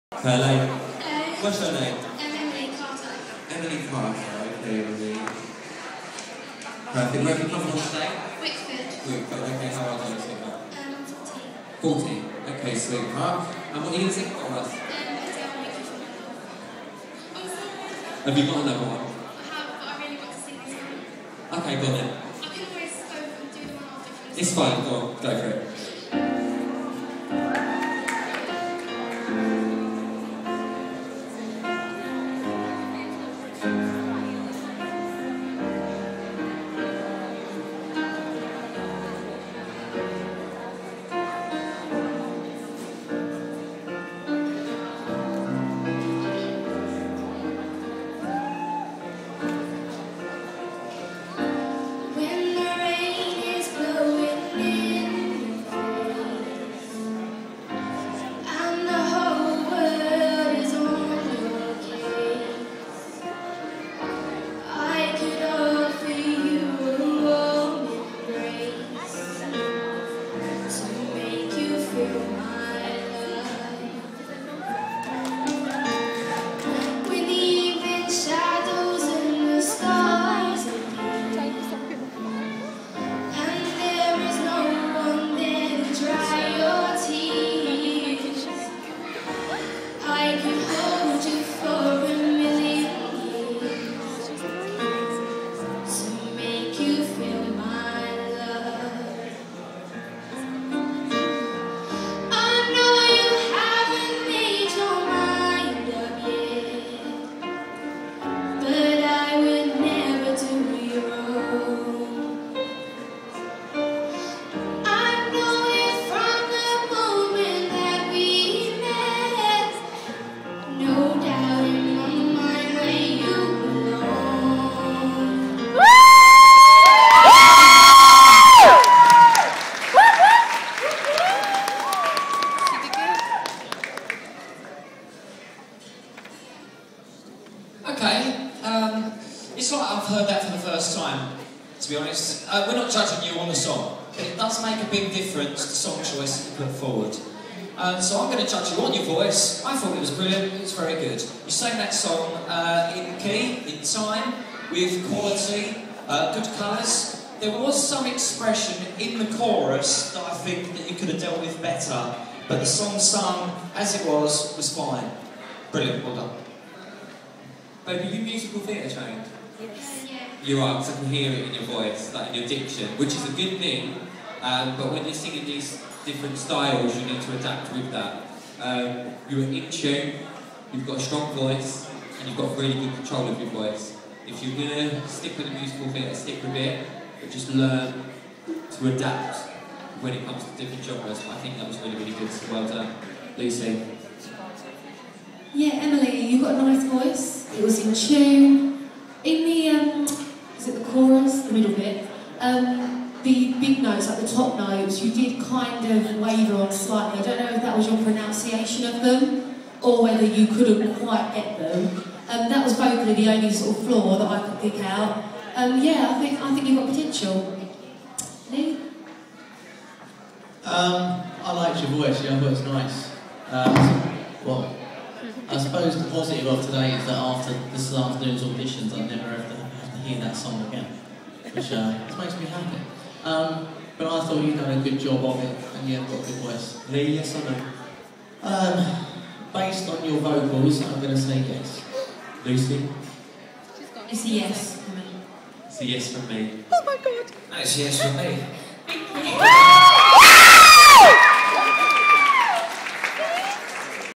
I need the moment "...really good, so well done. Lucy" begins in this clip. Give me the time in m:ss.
3:11.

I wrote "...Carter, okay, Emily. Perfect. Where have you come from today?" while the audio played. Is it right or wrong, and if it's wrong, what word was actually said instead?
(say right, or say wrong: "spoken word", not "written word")
right.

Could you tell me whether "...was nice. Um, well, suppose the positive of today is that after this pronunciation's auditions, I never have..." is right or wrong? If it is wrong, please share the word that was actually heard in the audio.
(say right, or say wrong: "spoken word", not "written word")
wrong: "afternoon", not "pronunciation".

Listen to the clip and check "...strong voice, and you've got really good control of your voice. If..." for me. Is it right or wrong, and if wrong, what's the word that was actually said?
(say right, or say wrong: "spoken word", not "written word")
right.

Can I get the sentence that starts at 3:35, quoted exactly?
Um, yeah, I think I think you've got potential.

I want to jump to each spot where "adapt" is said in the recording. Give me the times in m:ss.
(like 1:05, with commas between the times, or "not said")
2:57, 3:08.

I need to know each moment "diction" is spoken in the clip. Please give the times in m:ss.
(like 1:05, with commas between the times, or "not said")
2:52.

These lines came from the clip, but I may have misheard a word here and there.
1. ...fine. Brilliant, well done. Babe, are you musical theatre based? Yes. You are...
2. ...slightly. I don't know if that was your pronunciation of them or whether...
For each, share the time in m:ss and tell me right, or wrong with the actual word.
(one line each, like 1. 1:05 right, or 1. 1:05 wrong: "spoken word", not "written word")
1. 2:44 wrong: "trained", not "based"
2. 3:26 right.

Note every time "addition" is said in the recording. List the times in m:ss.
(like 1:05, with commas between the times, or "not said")
not said.